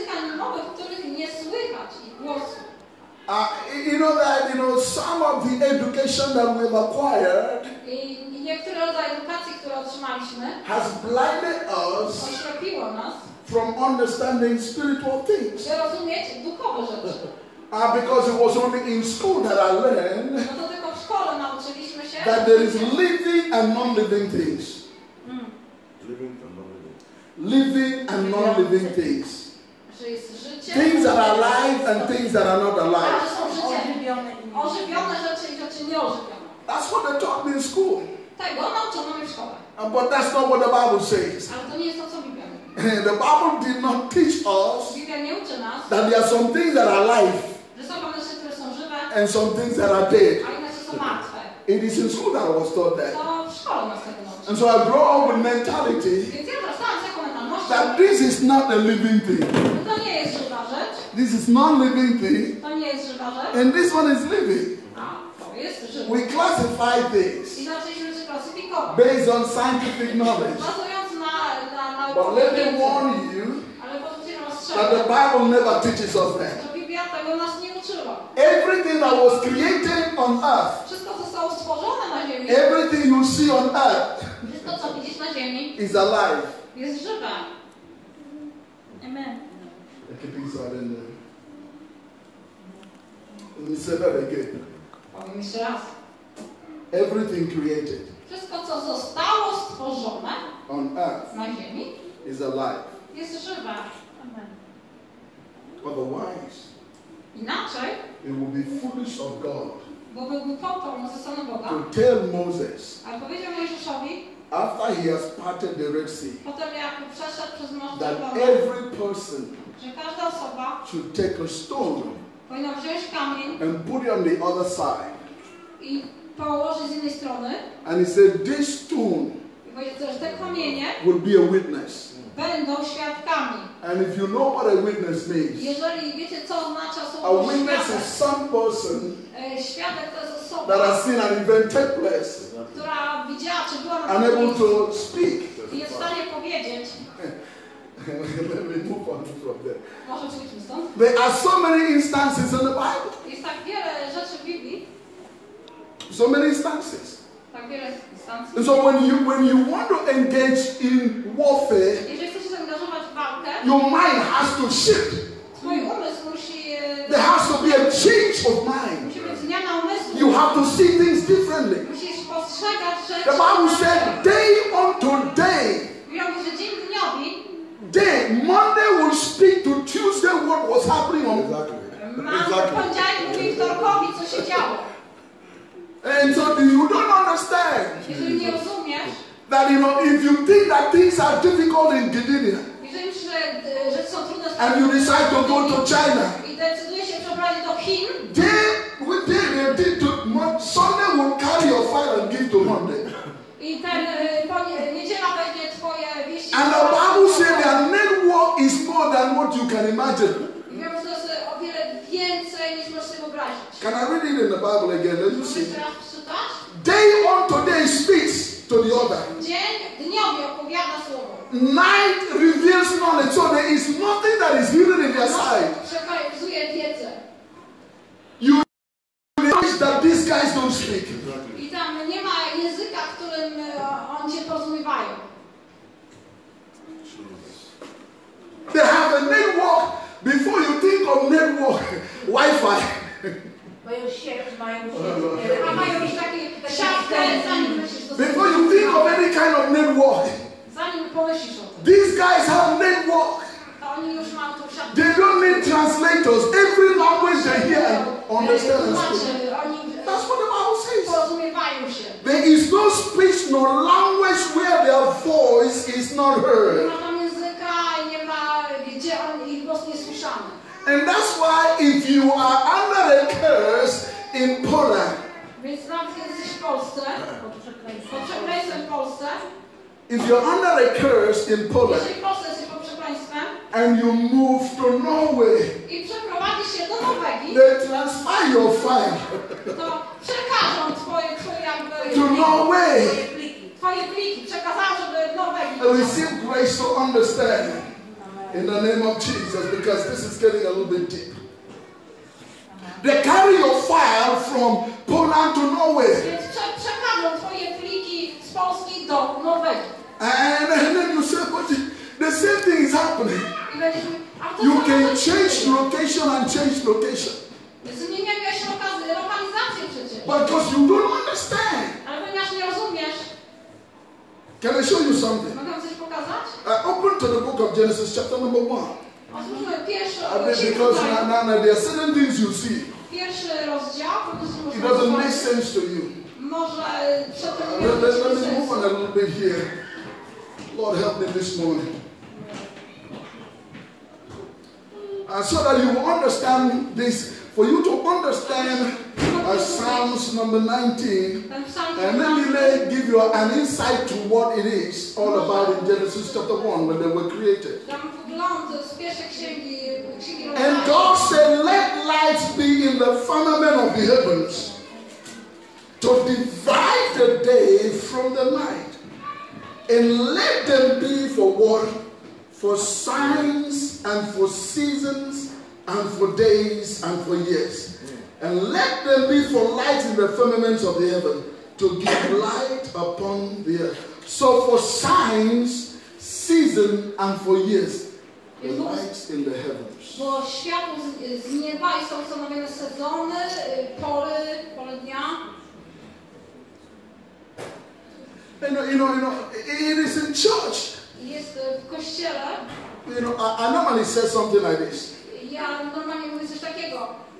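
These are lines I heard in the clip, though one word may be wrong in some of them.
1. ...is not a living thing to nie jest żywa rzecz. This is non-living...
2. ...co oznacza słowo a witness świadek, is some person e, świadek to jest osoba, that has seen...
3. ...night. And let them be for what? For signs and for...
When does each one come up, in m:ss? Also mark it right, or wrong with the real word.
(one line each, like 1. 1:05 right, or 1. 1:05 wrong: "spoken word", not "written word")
1. 0:58 right
2. 2:16 right
3. 6:08 right.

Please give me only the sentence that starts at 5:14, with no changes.
You can change location and change location.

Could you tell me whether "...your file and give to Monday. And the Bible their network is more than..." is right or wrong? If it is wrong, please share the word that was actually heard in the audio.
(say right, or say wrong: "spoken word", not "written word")
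right.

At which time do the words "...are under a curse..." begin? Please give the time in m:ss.
4:32.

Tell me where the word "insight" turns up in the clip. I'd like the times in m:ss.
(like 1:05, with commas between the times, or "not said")
5:53.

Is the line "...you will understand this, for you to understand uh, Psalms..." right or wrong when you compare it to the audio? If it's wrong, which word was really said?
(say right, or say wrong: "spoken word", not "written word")
right.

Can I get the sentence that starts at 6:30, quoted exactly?
Bo światło z, z nieba i są ustanowione sezony, pory, pole dnia.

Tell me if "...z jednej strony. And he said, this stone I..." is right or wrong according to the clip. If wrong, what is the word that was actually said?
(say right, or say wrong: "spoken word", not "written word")
right.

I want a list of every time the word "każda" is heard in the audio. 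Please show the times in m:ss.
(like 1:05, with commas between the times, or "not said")
2:00.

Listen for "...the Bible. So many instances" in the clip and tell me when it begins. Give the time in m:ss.
2:32.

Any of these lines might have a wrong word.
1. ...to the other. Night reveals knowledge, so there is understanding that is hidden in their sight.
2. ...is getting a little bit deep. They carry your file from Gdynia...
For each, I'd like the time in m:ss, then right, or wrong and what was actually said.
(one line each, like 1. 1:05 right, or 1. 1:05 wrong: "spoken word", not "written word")
1. 3:38 wrong: "nothing", not "understanding"
2. 5:00 wrong: "Poland", not "Gdynia".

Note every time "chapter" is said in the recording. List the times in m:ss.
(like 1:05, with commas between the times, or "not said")
5:28, 5:56.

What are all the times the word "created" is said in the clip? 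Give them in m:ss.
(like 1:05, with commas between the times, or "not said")
1:19, 1:37, 5:57.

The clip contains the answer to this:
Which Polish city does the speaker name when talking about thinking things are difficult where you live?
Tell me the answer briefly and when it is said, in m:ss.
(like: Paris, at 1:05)
Gdynia, at 3:12.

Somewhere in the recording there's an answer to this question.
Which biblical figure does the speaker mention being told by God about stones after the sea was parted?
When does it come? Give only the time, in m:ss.
1:52.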